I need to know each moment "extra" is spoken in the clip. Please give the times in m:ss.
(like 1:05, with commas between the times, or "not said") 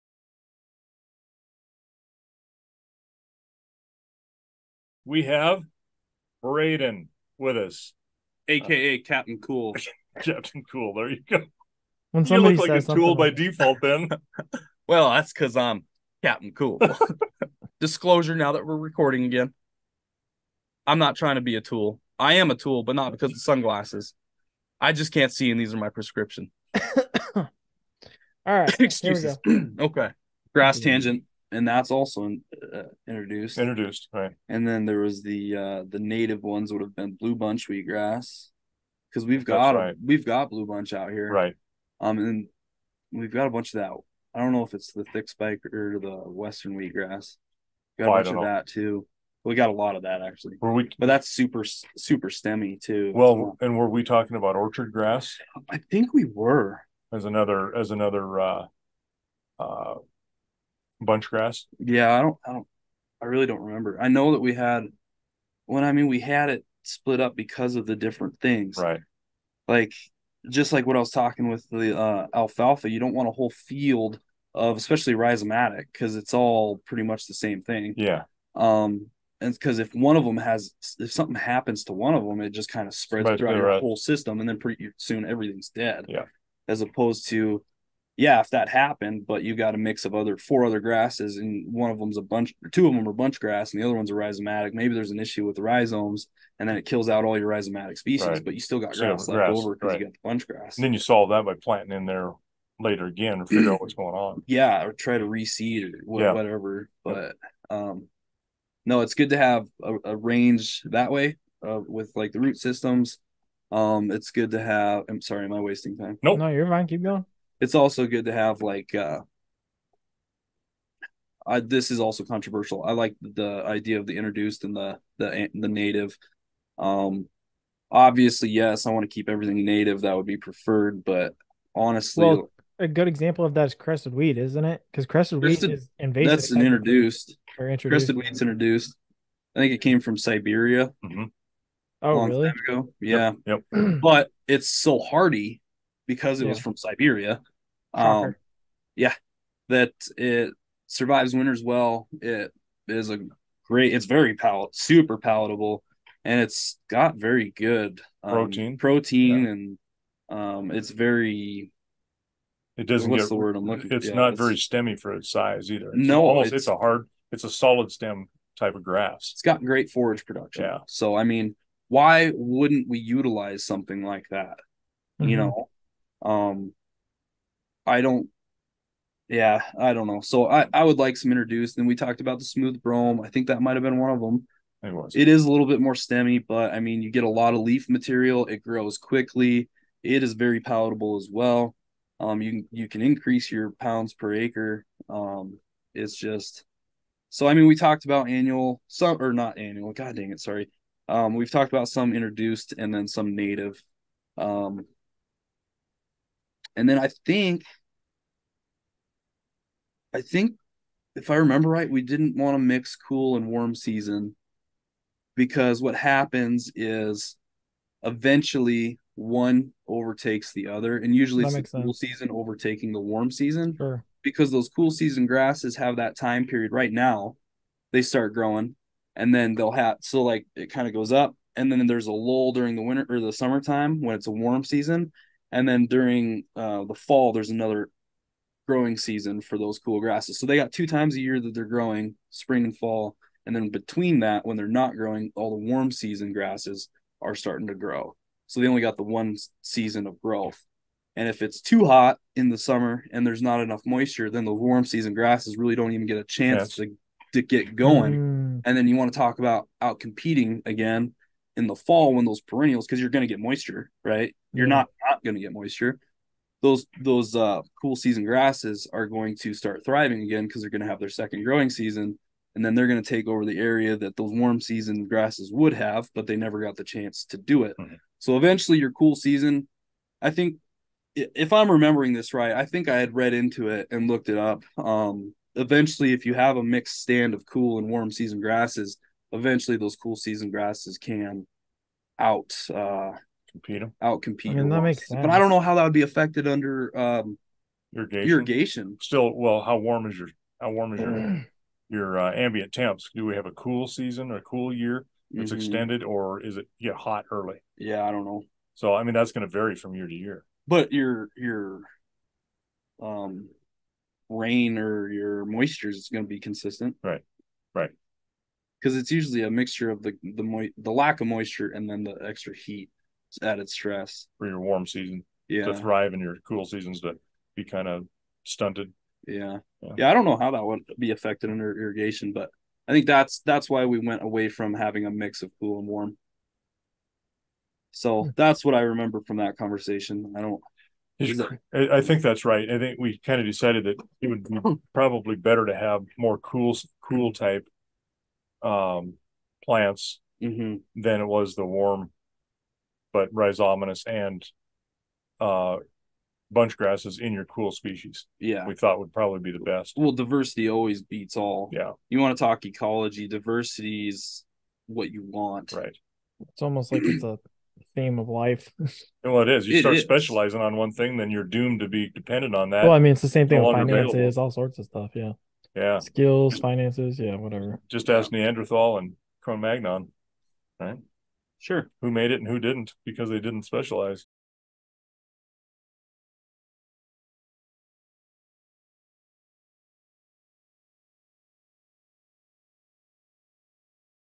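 5:22.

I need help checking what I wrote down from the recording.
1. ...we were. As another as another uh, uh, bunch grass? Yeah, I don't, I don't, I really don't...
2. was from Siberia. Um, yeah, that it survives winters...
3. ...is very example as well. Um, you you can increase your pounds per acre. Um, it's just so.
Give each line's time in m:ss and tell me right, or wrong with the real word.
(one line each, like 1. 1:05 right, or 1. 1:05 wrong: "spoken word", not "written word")
1. 0:56 right
2. 2:26 right
3. 3:10 wrong: "palatable", not "example".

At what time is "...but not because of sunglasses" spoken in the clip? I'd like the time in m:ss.
0:22.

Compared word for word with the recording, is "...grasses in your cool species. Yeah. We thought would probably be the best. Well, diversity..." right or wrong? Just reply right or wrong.
right.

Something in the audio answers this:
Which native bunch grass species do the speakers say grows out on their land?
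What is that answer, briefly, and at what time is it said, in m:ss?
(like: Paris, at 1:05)
blue bunch wheatgrass, at 0:37.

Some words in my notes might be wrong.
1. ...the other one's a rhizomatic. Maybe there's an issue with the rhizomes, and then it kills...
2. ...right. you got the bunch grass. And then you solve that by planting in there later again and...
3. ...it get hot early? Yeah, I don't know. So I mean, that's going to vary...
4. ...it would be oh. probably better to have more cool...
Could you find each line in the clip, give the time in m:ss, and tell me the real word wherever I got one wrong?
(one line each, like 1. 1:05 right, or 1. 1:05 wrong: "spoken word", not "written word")
1. 1:33 right
2. 1:39 right
3. 5:06 right
4. 5:44 right.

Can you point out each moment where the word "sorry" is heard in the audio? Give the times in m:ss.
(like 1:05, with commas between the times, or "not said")
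1:55, 3:20.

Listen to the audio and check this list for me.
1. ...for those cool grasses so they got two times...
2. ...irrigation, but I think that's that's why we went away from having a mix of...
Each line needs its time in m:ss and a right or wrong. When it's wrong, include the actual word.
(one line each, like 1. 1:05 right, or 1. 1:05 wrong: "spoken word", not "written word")
1. 3:59 right
2. 5:31 right.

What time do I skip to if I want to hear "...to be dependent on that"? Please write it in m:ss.
6:11.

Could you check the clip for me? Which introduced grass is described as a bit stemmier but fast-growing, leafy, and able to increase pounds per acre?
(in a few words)
smooth brome.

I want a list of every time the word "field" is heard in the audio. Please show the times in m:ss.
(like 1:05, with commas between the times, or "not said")
1:13.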